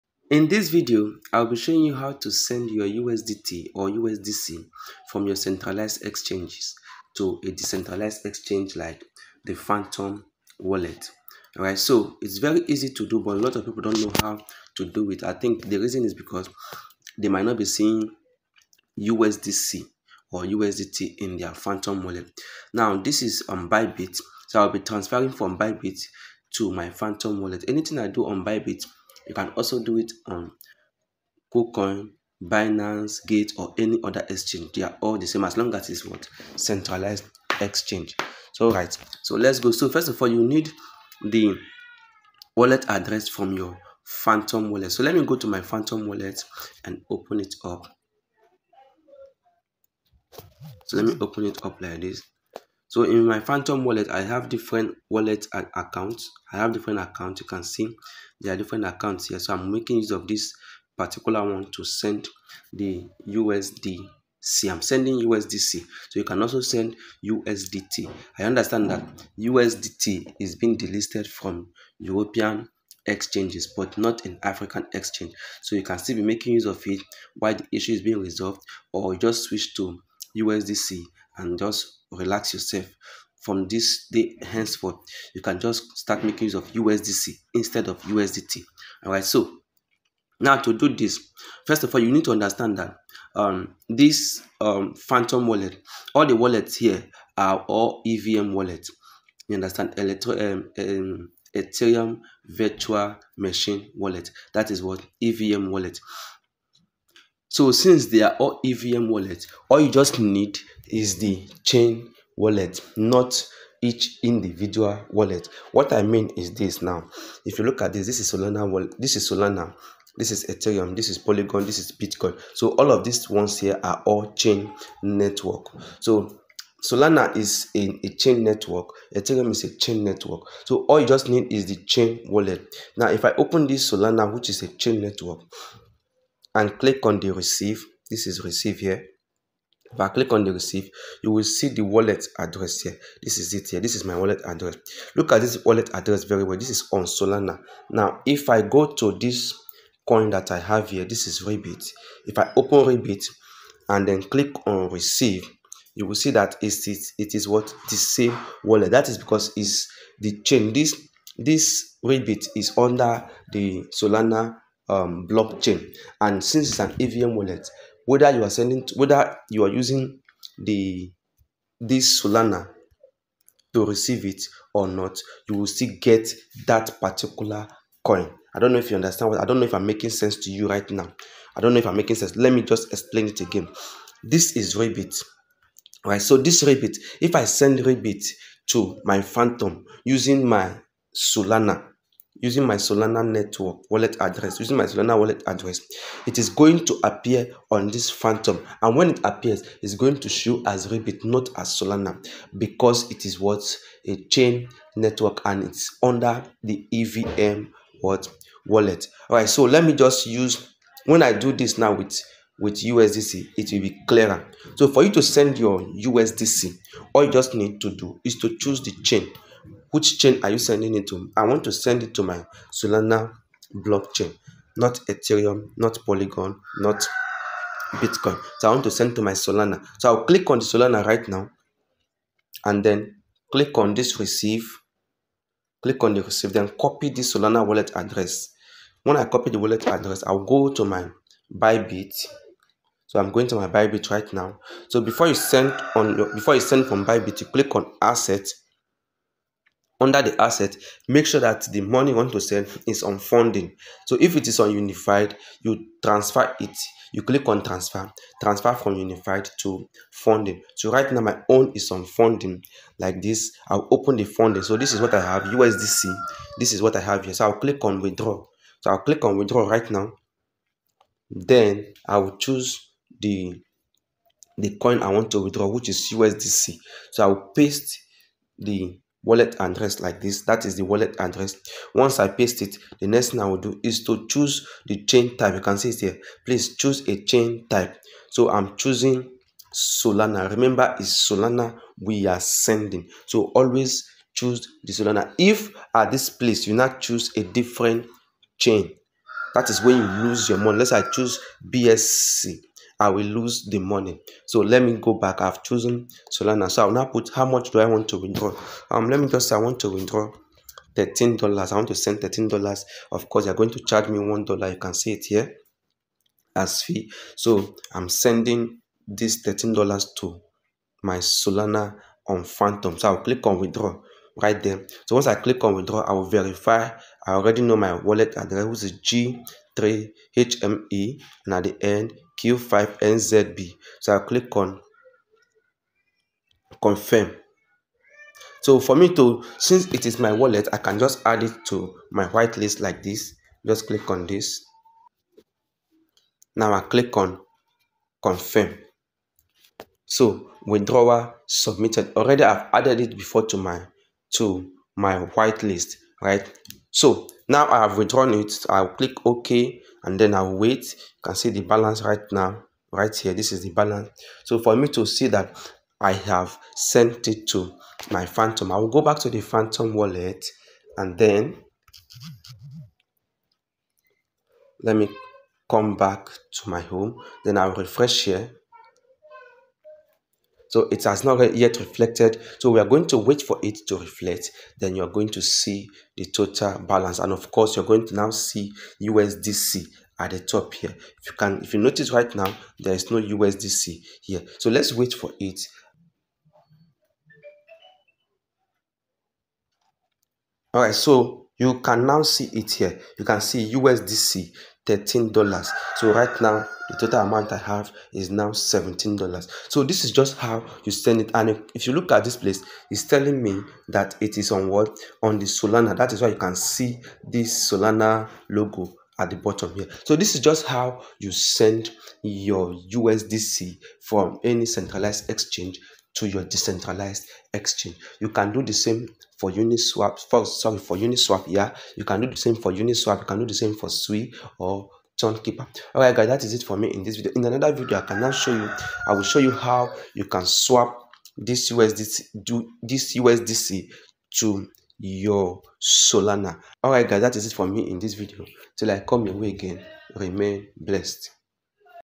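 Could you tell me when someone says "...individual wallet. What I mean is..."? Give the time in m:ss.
1:54.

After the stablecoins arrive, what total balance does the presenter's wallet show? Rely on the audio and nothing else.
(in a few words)
$17.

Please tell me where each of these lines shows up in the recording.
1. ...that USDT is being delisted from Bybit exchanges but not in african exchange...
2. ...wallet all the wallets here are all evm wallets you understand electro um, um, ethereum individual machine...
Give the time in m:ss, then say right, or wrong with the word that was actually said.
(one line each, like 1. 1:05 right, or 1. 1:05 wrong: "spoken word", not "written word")
1. 1:08 wrong: "European", not "Bybit"
2. 1:35 wrong: "virtual", not "individual".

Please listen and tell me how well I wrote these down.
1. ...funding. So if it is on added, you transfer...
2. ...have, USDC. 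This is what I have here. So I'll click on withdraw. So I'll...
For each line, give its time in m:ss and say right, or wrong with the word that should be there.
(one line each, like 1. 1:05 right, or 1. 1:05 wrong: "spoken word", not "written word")
1. 4:13 wrong: "unified", not "added"
2. 4:25 right.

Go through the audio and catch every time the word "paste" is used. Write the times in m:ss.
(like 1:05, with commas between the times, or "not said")
4:37, 4:42.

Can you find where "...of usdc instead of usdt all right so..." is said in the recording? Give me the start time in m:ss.
1:26.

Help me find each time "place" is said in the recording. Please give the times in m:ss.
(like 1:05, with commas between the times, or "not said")
4:56, 6:52.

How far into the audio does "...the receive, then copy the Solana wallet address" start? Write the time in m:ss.
3:56.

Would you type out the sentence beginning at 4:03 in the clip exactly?
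So I'm going to my Bybit right now.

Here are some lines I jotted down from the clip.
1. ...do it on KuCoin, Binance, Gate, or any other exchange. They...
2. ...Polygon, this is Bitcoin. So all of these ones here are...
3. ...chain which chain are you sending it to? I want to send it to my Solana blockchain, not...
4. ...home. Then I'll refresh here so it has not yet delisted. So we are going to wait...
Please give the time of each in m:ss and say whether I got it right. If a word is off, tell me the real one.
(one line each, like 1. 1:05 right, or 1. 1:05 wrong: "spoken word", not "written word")
1. 0:29 right
2. 2:01 right
3. 3:39 right
4. 6:16 wrong: "reflected", not "delisted".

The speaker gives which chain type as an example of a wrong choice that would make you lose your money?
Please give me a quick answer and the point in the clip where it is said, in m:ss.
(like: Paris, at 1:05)
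BSC, at 5:01.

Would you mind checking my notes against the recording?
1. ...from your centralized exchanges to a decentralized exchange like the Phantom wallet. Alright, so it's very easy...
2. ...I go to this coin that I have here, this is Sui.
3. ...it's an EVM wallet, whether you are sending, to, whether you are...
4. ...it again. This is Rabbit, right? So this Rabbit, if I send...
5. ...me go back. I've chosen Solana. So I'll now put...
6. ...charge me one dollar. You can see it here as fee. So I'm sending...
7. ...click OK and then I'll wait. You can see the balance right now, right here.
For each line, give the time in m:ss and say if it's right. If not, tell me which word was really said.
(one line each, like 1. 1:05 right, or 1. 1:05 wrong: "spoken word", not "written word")
1. 0:05 right
2. 2:28 wrong: "Rebit", not "Sui"
3. 2:46 right
4. 3:03 right
5. 5:04 right
6. 5:13 right
7. 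5:58 right.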